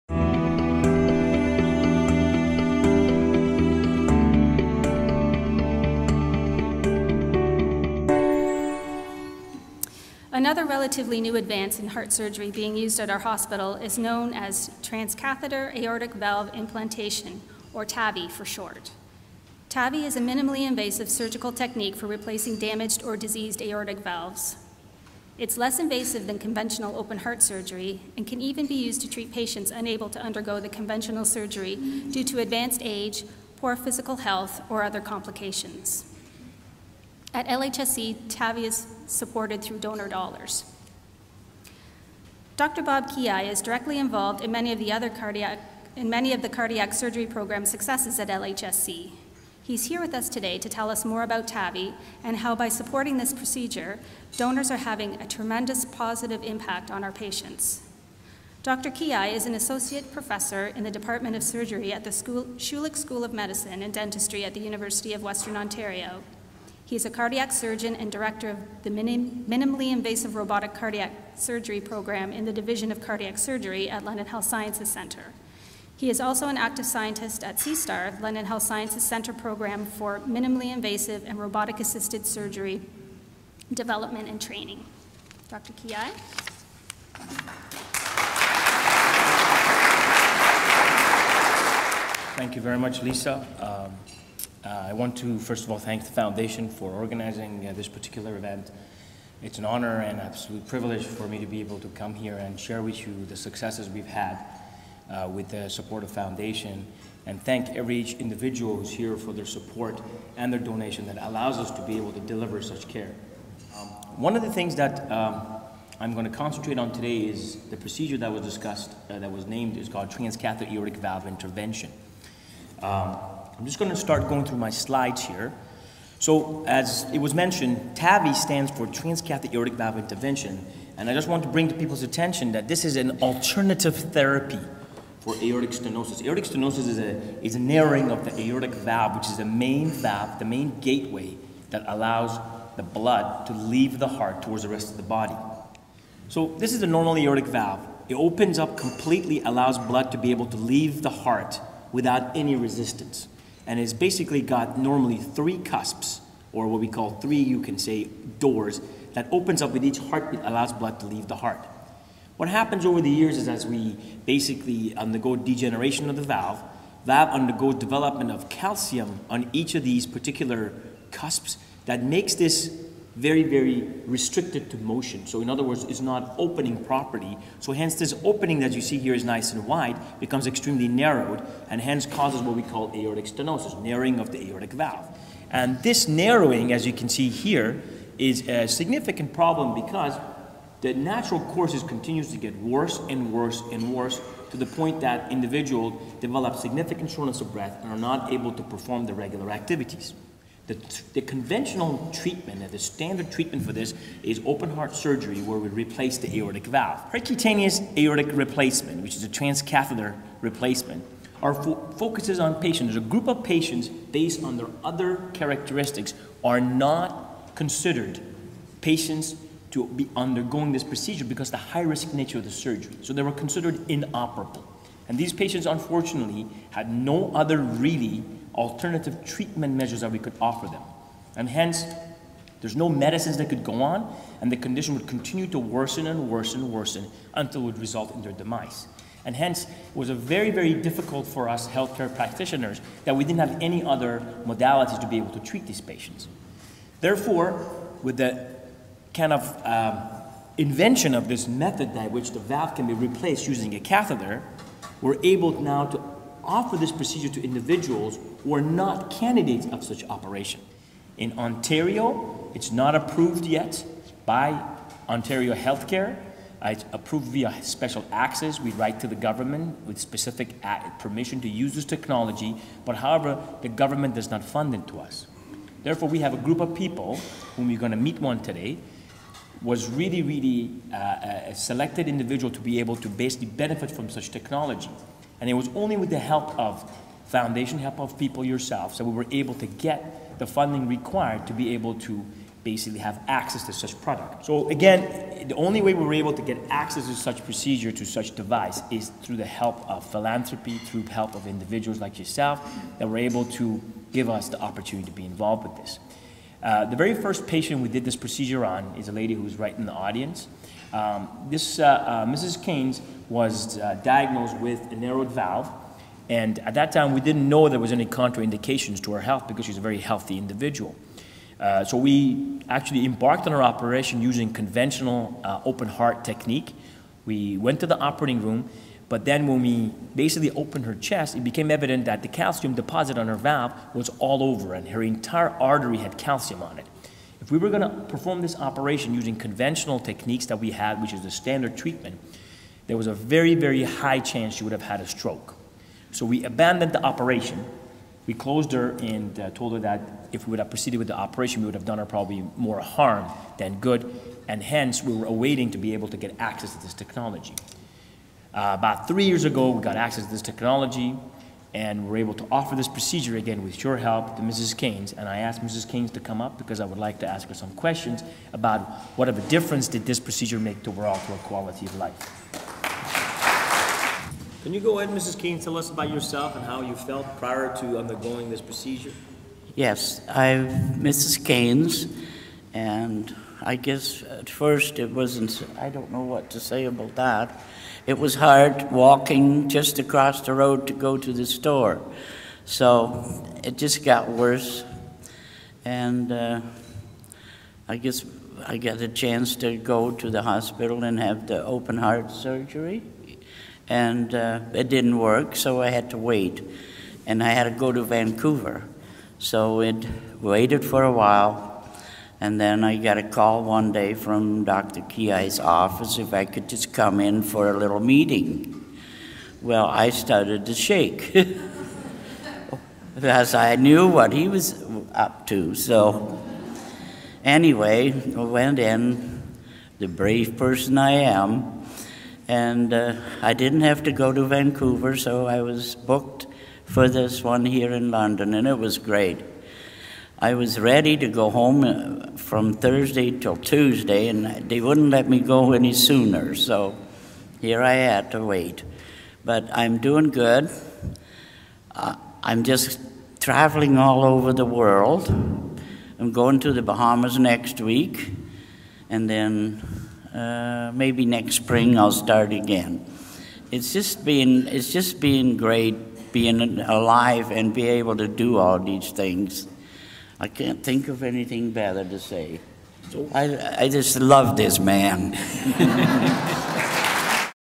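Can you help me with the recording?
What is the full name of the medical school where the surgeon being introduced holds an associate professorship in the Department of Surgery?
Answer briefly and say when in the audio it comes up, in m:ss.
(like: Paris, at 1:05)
Schulich School of Medicine and Dentistry, at 1:02.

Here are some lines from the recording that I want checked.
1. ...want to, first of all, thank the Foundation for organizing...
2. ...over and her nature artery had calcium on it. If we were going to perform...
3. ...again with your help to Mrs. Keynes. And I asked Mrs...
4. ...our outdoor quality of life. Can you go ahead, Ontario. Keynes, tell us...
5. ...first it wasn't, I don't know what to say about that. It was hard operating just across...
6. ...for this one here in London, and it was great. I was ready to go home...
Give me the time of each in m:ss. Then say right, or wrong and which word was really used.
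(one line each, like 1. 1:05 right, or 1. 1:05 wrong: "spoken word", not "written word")
1. 1:34 right
2. 5:34 wrong: "entire", not "nature"
3. 6:03 right
4. 6:10 wrong: "Mrs", not "Ontario"
5. 6:24 wrong: "walking", not "operating"
6. 7:16 right.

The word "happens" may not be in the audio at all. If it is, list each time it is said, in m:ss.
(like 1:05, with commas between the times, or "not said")
2:42.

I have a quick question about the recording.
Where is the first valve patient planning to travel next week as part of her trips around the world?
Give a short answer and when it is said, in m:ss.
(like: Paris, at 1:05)
the Bahamas, at 7:36.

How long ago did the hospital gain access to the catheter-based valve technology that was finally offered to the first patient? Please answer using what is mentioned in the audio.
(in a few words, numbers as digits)
about 3 years.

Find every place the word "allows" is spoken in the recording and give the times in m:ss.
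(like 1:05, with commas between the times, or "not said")
1:51, 2:21, 2:29, 2:40.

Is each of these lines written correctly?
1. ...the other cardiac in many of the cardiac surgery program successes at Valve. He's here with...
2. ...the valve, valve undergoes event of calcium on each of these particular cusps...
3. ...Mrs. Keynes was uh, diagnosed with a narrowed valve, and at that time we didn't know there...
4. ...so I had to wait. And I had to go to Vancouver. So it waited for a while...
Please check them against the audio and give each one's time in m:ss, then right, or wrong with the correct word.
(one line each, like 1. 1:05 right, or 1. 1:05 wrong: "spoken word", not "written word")
1. 0:44 wrong: "LHSC", not "Valve"
2. 2:46 wrong: "development", not "event"
3. 5:12 right
4. 6:45 right.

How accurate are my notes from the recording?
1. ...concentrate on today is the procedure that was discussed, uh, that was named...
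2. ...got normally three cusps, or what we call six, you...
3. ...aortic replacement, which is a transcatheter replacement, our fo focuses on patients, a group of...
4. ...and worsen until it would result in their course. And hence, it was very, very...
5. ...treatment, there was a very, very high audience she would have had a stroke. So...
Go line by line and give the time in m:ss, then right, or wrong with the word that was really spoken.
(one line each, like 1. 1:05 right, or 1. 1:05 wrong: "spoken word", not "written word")
1. 1:56 right
2. 2:34 wrong: "three", not "six"
3. 3:27 right
4. 3:56 wrong: "demise", not "course"
5. 5:41 wrong: "chance", not "audience".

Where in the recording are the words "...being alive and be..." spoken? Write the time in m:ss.
7:46.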